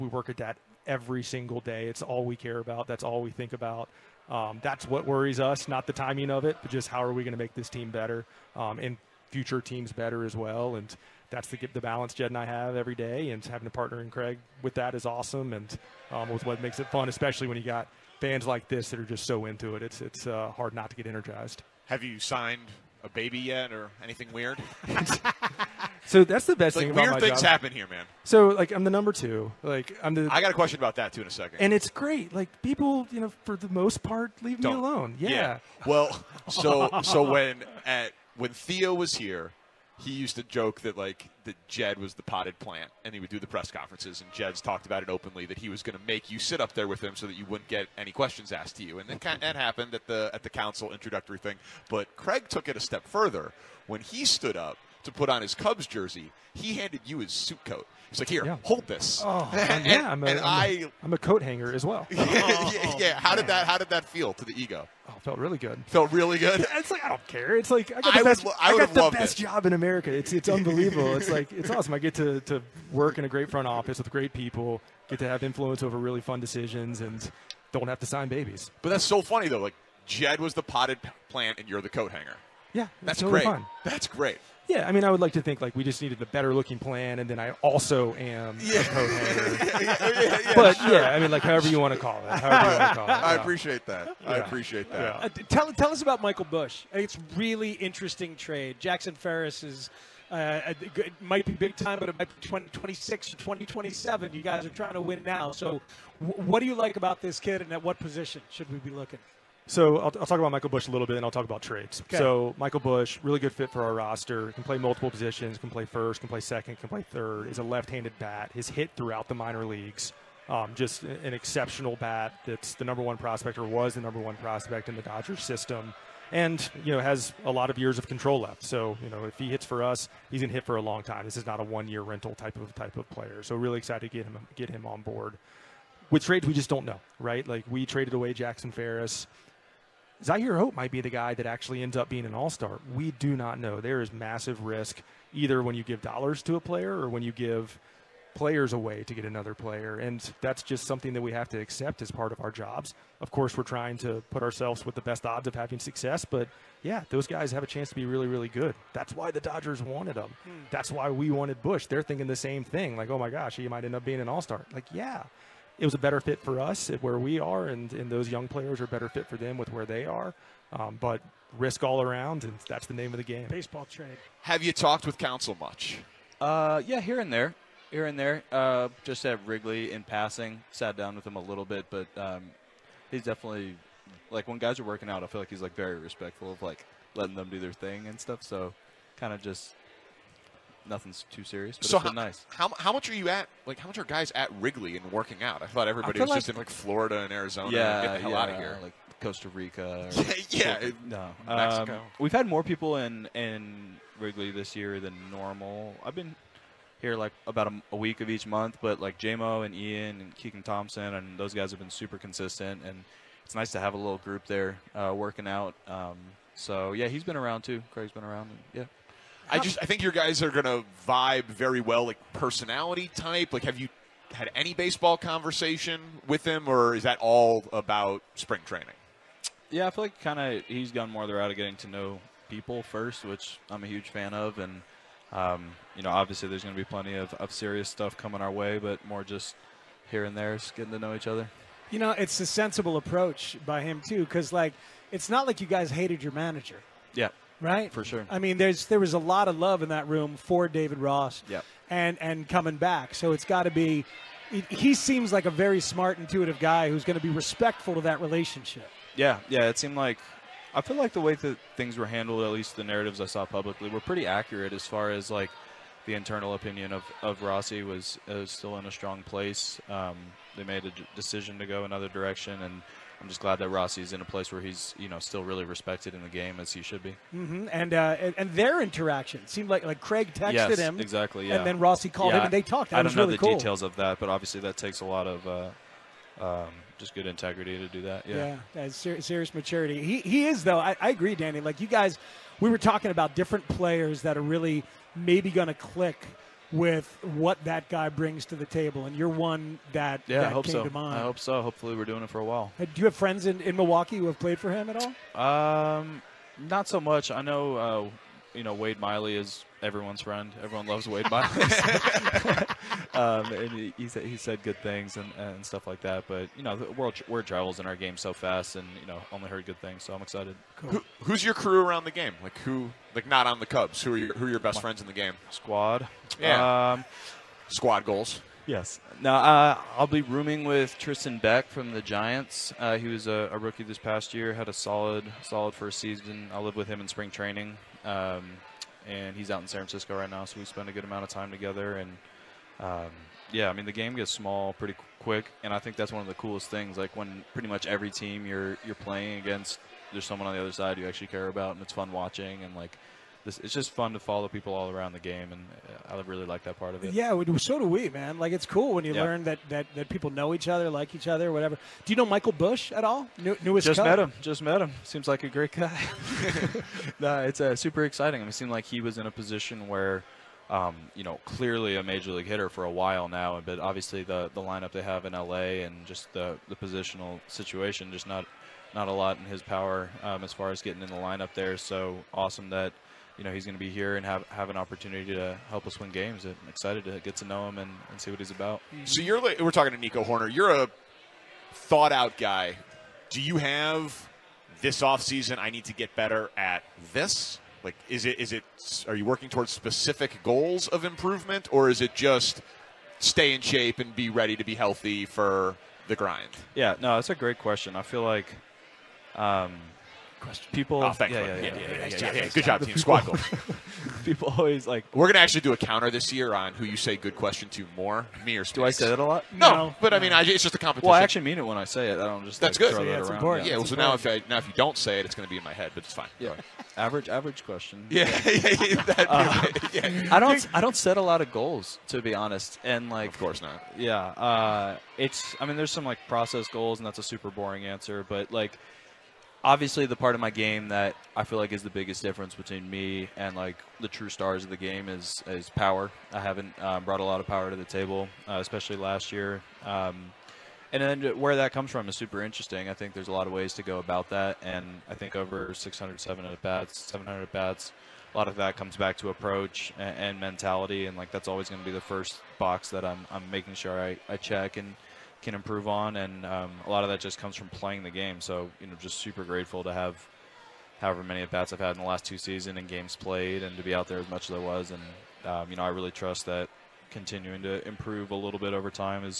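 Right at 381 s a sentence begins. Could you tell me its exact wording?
So awesome that you know he's going to be here and have, have an opportunity to help us win games.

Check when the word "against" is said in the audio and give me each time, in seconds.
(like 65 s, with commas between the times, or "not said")
349 s.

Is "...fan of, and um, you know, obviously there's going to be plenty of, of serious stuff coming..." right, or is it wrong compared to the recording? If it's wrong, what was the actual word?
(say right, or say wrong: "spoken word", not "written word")
right.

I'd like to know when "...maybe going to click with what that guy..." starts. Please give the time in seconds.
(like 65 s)
295 s.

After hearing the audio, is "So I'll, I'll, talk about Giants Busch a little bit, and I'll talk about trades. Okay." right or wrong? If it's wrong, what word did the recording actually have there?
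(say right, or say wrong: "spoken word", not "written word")
wrong: "Michael", not "Giants".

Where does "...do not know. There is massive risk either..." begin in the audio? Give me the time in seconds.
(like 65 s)
143 s.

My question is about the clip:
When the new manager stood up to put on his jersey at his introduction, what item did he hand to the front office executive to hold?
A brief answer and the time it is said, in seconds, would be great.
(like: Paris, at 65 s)
suit coat, at 57 s.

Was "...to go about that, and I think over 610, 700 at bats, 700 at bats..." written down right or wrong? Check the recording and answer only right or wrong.
wrong.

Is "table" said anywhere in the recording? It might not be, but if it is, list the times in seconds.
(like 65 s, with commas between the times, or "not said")
298 s, 447 s.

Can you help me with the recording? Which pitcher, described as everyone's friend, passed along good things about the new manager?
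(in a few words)
Wade Miley.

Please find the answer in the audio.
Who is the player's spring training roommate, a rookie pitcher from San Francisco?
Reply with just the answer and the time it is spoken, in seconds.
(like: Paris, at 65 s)
Tristan Beck, at 330 s.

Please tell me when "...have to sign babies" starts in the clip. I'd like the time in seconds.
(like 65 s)
77 s.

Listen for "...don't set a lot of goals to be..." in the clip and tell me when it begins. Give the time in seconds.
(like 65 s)
430 s.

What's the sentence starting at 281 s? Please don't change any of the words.
and then Rossi called yeah, him and they talked.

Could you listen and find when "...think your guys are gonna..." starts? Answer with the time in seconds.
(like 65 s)
219 s.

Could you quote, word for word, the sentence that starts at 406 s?
Yeah, no, that's a great question.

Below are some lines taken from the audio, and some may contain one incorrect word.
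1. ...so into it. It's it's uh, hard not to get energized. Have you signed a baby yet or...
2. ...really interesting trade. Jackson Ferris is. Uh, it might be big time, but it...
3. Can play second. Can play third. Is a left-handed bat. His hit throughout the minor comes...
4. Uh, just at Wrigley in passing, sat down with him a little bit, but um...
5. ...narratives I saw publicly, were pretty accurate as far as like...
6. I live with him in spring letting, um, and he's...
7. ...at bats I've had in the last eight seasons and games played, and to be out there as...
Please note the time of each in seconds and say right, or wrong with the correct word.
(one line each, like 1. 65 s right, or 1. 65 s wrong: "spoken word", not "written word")
1. 19 s right
2. 97 s right
3. 116 s wrong: "leagues", not "comes"
4. 178 s right
5. 262 s right
6. 336 s wrong: "training", not "letting"
7. 471 s wrong: "two", not "eight".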